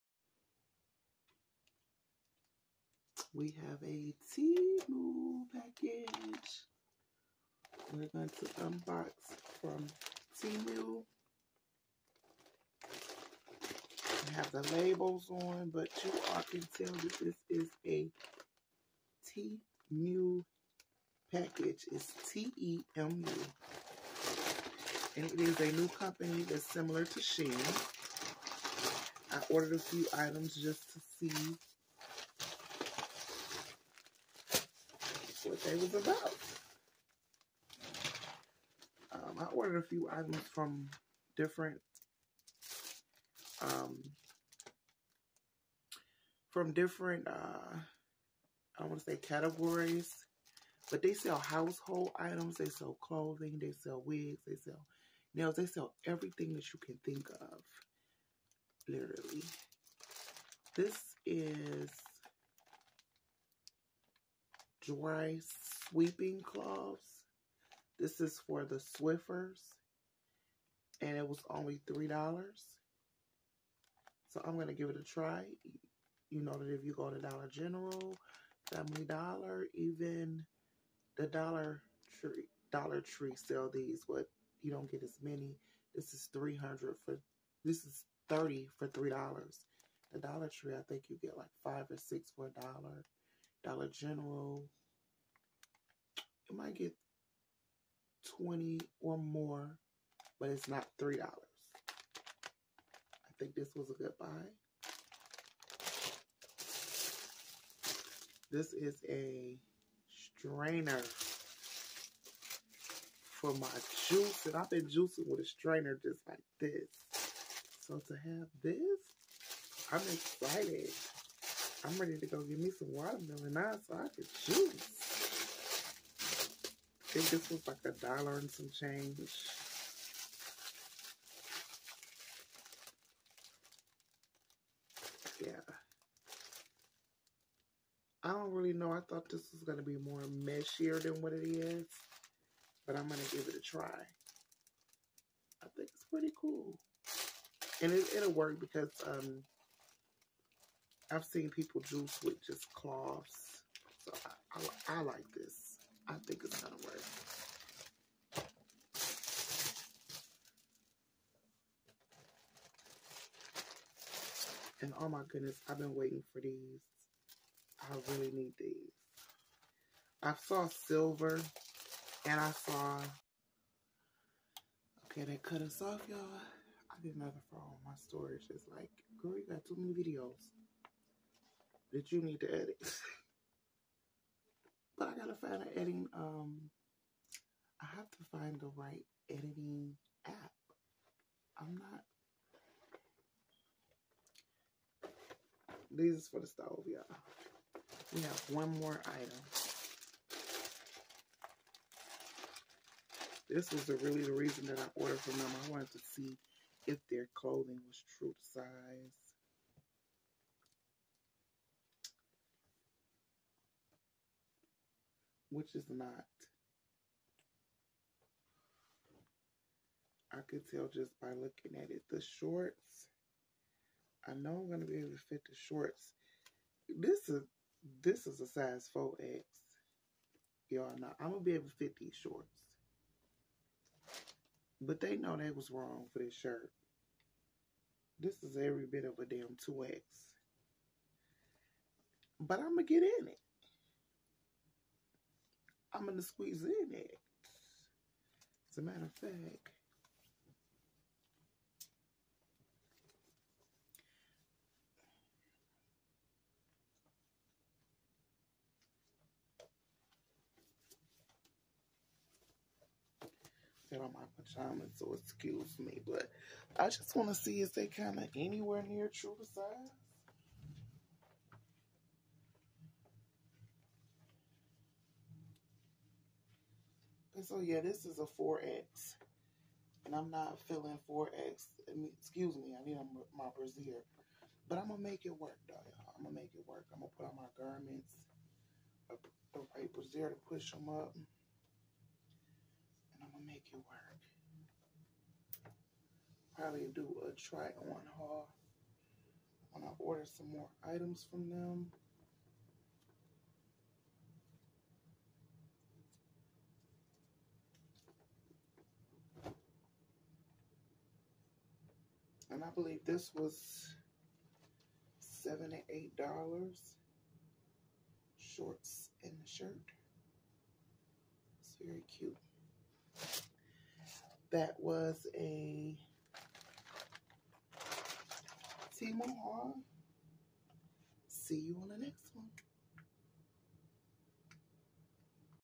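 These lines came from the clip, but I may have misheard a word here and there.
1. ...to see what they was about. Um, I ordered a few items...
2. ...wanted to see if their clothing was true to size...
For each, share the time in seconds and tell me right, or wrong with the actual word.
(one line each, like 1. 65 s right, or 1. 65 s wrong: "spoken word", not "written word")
1. 30 s right
2. 205 s right.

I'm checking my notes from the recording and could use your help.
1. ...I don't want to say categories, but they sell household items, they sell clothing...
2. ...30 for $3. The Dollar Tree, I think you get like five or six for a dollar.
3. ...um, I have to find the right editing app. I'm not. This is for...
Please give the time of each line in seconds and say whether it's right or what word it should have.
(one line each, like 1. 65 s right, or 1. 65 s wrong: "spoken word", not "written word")
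1. 47 s right
2. 88 s right
3. 186 s right.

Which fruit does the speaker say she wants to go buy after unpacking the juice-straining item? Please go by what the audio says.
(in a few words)
watermelon.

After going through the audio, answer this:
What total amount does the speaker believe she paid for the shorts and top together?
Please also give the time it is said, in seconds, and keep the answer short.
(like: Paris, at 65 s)
$78, at 315 s.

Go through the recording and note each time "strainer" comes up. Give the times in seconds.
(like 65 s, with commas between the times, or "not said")
110 s, 115 s.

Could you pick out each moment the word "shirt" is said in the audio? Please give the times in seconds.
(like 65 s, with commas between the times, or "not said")
236 s, 319 s.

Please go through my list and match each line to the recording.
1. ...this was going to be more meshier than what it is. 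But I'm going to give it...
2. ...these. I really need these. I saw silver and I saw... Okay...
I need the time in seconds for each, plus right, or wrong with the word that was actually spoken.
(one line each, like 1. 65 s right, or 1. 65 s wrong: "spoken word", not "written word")
1. 139 s right
2. 166 s right.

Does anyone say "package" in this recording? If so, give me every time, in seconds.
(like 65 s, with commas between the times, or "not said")
5 s, 21 s.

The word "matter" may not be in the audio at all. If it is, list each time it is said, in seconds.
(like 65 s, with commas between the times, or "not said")
248 s.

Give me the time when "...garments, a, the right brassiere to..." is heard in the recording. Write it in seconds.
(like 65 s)
287 s.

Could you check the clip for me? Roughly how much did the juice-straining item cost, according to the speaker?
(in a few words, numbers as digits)
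a dollar and some change.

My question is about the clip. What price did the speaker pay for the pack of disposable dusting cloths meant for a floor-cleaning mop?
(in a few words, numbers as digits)
$3.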